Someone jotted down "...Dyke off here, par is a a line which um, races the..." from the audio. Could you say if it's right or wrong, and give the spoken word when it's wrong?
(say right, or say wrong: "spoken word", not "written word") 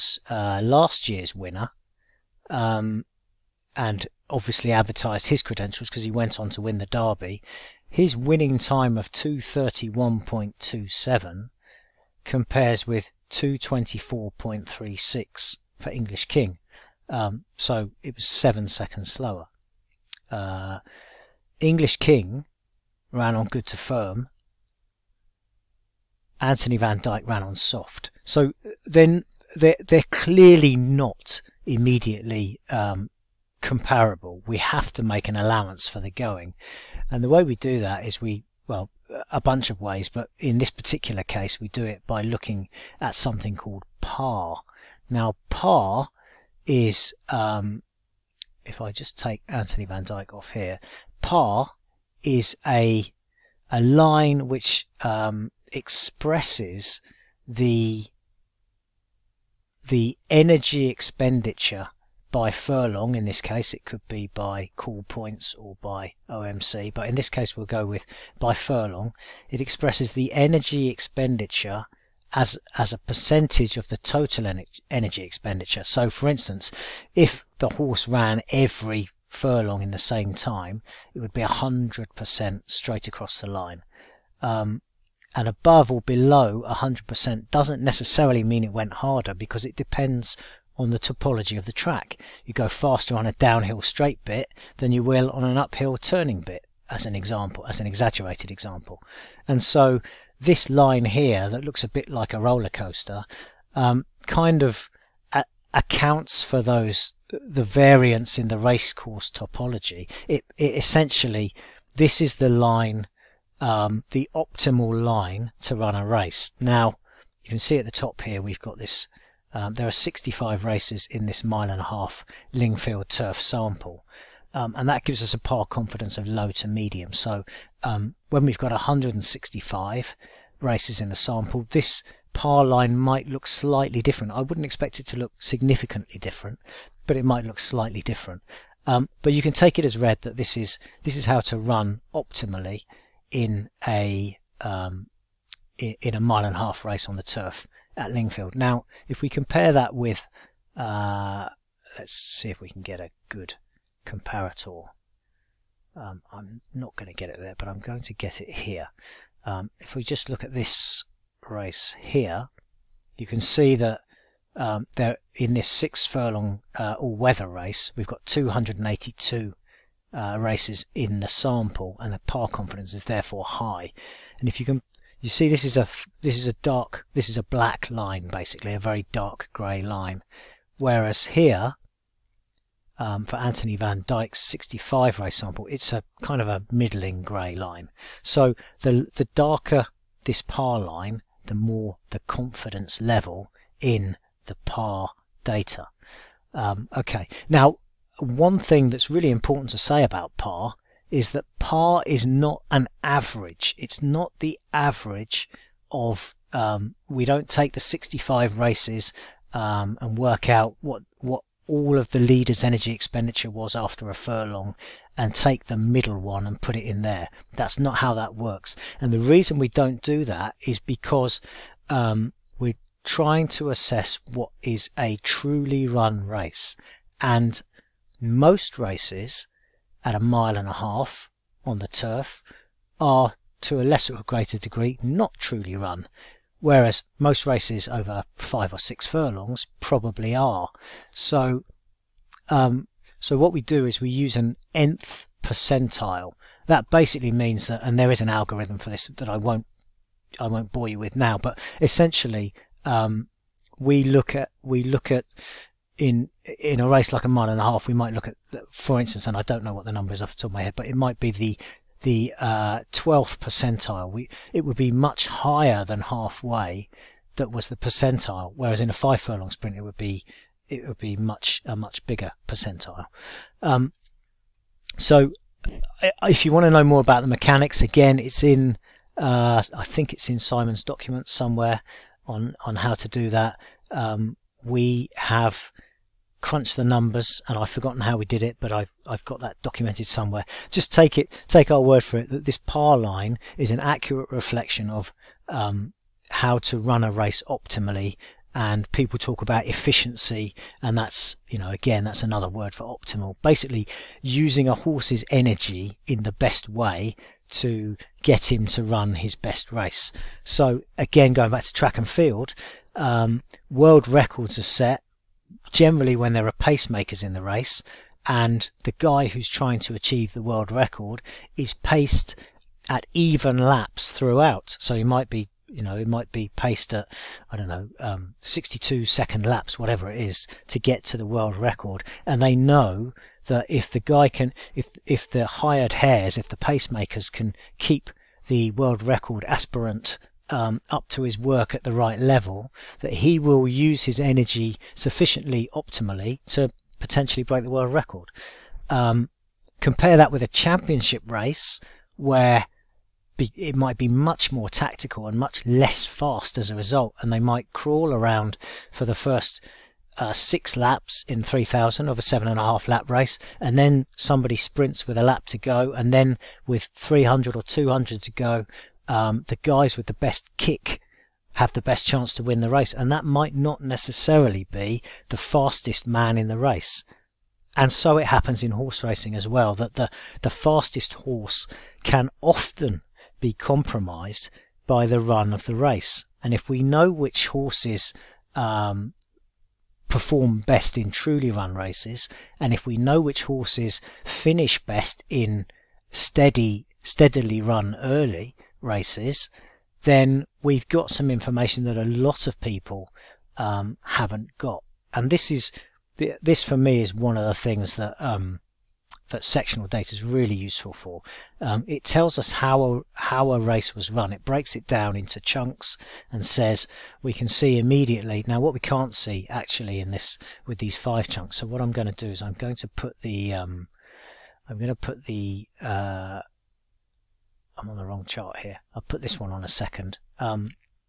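wrong: "expresses", not "races".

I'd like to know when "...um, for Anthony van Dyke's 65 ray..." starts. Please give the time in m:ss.
3:02.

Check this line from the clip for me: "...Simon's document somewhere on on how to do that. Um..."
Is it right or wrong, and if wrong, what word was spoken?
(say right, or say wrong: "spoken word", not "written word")
right.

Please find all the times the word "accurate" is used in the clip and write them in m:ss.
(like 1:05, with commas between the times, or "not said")
4:53.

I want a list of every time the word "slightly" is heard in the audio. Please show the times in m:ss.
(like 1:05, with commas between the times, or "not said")
2:13, 2:17.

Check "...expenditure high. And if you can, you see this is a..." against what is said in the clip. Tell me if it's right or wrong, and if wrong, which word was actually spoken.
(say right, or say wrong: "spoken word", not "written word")
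wrong: "therefore", not "expenditure".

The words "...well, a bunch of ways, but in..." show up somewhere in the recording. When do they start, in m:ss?
0:38.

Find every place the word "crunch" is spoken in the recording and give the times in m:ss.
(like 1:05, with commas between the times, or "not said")
4:46.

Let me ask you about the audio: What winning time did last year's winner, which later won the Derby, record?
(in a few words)
231.27.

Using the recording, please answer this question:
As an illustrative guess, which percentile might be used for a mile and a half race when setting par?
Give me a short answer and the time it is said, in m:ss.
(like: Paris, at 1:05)
12th percentile, at 4:22.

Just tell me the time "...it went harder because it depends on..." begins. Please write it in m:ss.
1:28.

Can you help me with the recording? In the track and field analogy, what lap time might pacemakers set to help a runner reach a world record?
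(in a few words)
62 seconds.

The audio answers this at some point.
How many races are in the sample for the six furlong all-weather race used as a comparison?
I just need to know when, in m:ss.
2:48.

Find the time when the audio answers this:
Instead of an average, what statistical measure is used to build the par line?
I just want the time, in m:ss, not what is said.
4:04.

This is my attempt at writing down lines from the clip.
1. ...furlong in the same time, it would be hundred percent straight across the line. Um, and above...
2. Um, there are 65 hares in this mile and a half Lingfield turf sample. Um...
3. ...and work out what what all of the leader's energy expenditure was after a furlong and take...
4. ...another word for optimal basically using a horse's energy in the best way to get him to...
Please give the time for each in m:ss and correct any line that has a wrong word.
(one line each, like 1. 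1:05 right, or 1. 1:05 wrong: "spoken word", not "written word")
1. 1:19 right
2. 1:59 wrong: "races", not "hares"
3. 3:30 right
4. 5:02 right.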